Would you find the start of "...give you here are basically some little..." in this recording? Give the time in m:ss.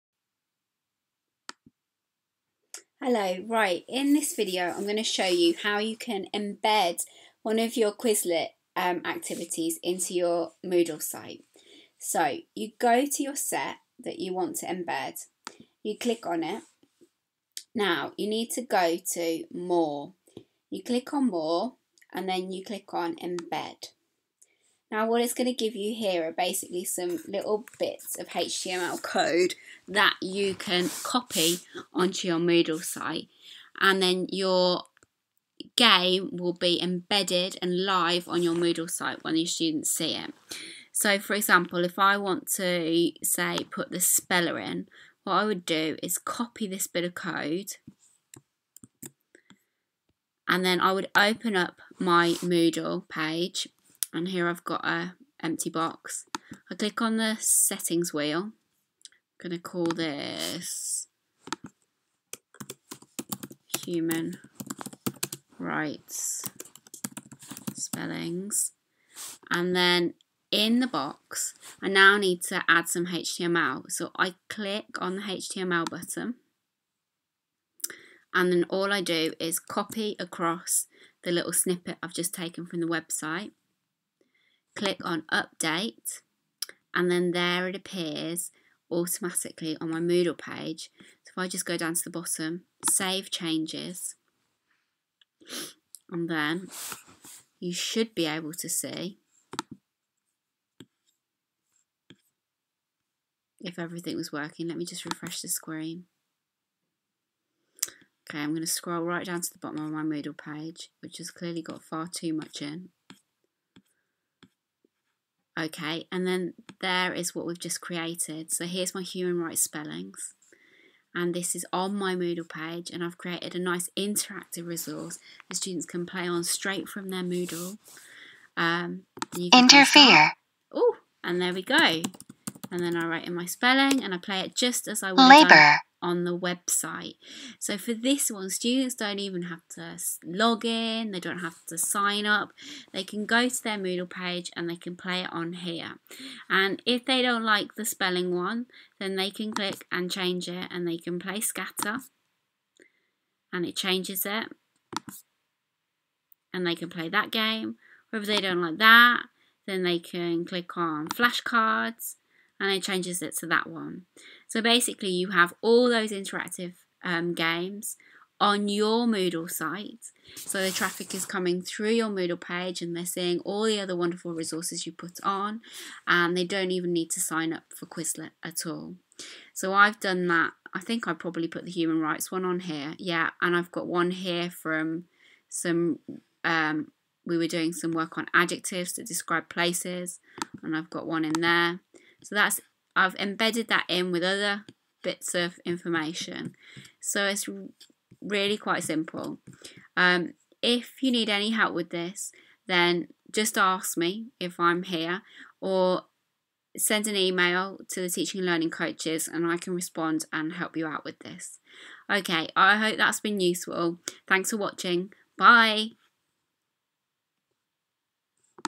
0:25.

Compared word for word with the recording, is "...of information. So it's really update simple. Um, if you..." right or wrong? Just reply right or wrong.
wrong.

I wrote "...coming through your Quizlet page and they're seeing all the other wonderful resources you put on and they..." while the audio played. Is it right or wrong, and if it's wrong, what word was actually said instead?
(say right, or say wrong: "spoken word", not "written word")
wrong: "Moodle", not "Quizlet".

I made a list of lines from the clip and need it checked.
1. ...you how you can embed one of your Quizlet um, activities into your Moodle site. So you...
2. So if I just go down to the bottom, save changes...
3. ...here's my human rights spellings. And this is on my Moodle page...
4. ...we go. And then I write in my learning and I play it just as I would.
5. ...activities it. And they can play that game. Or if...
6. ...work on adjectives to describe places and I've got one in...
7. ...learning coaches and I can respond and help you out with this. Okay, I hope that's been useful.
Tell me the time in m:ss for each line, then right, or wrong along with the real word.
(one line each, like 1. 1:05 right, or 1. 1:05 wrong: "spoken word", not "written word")
1. 0:05 right
2. 1:31 right
3. 1:58 right
4. 2:11 wrong: "spelling", not "learning"
5. 2:33 wrong: "changes", not "activities"
6. 3:07 right
7. 3:28 right.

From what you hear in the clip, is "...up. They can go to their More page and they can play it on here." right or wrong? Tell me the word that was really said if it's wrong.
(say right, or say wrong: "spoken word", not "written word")
wrong: "Moodle", not "More".